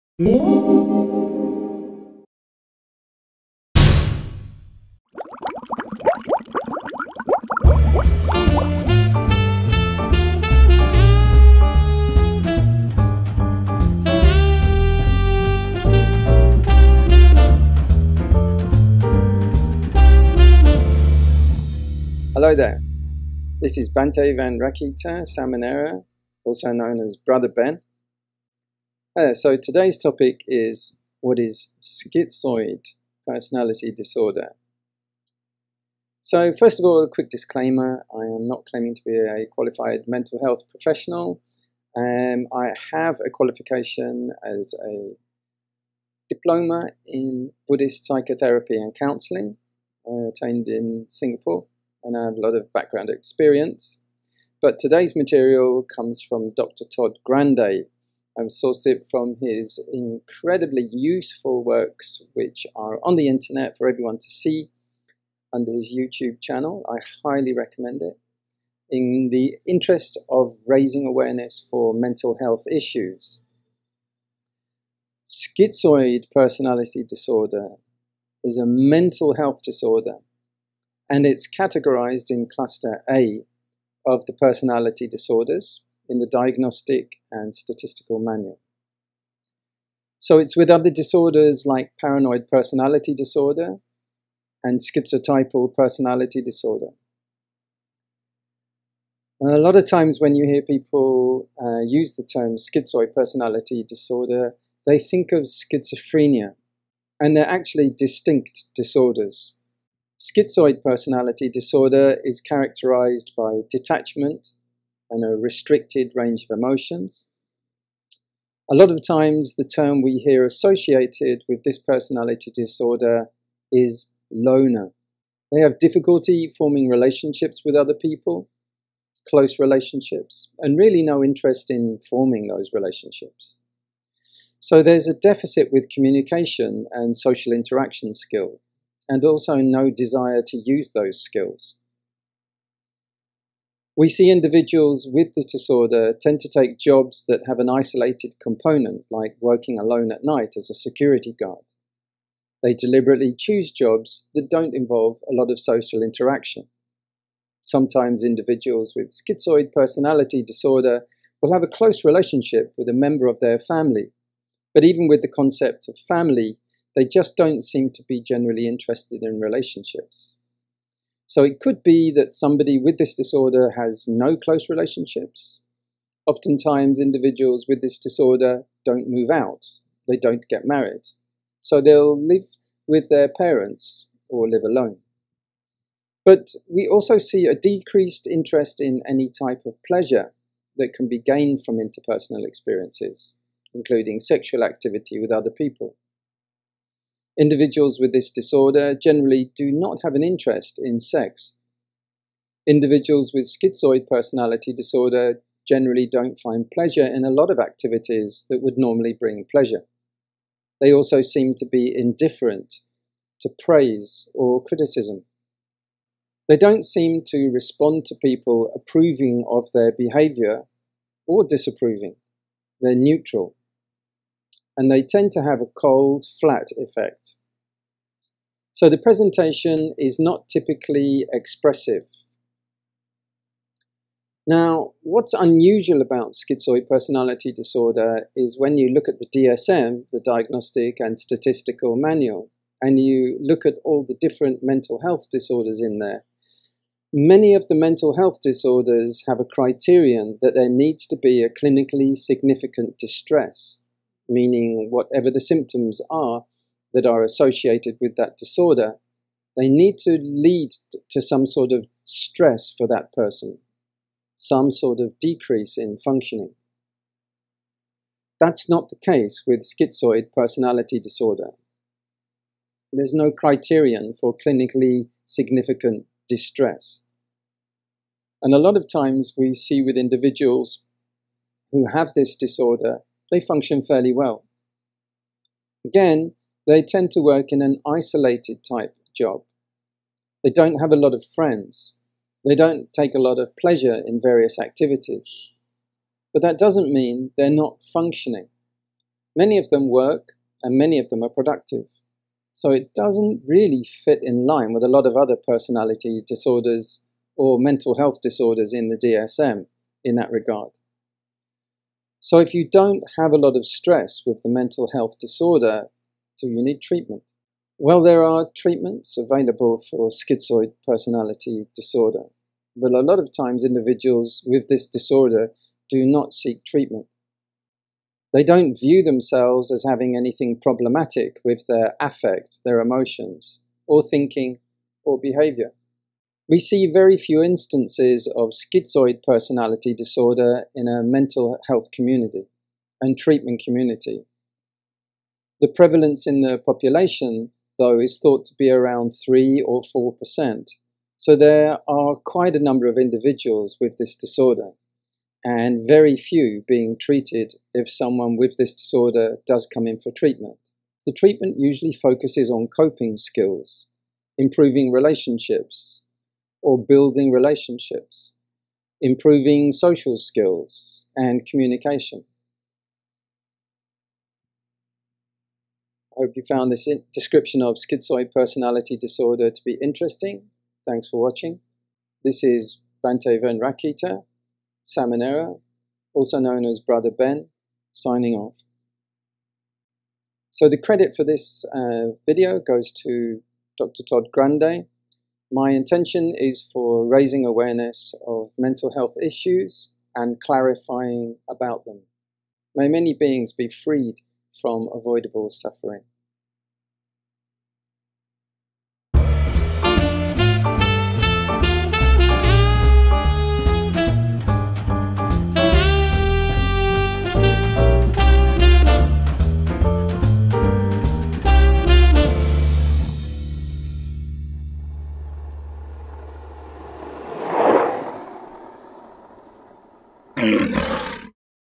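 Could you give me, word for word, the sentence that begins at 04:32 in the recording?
There's no criterion for clinically significant distress.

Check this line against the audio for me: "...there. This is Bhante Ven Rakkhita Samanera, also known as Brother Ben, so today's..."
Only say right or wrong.
right.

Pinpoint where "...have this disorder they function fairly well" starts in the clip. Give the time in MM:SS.
04:41.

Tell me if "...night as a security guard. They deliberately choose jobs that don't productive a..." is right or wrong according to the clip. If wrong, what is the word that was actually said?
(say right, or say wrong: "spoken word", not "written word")
wrong: "involve", not "productive".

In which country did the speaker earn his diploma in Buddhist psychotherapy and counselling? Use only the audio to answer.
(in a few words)
Singapore.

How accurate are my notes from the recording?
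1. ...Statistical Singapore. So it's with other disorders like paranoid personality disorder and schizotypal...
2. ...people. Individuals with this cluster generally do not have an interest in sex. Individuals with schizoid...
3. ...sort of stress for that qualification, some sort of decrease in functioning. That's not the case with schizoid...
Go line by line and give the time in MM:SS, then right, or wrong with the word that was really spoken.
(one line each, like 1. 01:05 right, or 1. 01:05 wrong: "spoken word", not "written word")
1. 01:27 wrong: "Manual", not "Singapore"
2. 03:15 wrong: "disorder", not "cluster"
3. 04:21 wrong: "person", not "qualification".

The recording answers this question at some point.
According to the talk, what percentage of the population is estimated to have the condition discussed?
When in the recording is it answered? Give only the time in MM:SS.
05:49.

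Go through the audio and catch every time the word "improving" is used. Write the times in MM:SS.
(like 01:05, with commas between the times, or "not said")
06:04, 06:09.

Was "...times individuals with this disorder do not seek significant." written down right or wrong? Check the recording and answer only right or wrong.
wrong.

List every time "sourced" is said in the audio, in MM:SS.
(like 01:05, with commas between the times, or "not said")
00:58.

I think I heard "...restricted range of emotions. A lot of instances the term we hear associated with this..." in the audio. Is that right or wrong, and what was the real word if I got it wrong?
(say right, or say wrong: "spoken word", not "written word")
wrong: "times", not "instances".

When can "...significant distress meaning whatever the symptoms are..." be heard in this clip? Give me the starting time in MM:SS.
04:12.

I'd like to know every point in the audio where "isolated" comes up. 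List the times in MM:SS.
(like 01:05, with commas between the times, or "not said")
02:27, 04:47.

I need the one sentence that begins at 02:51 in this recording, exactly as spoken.
So it could be that somebody with this disorder has no close relationships.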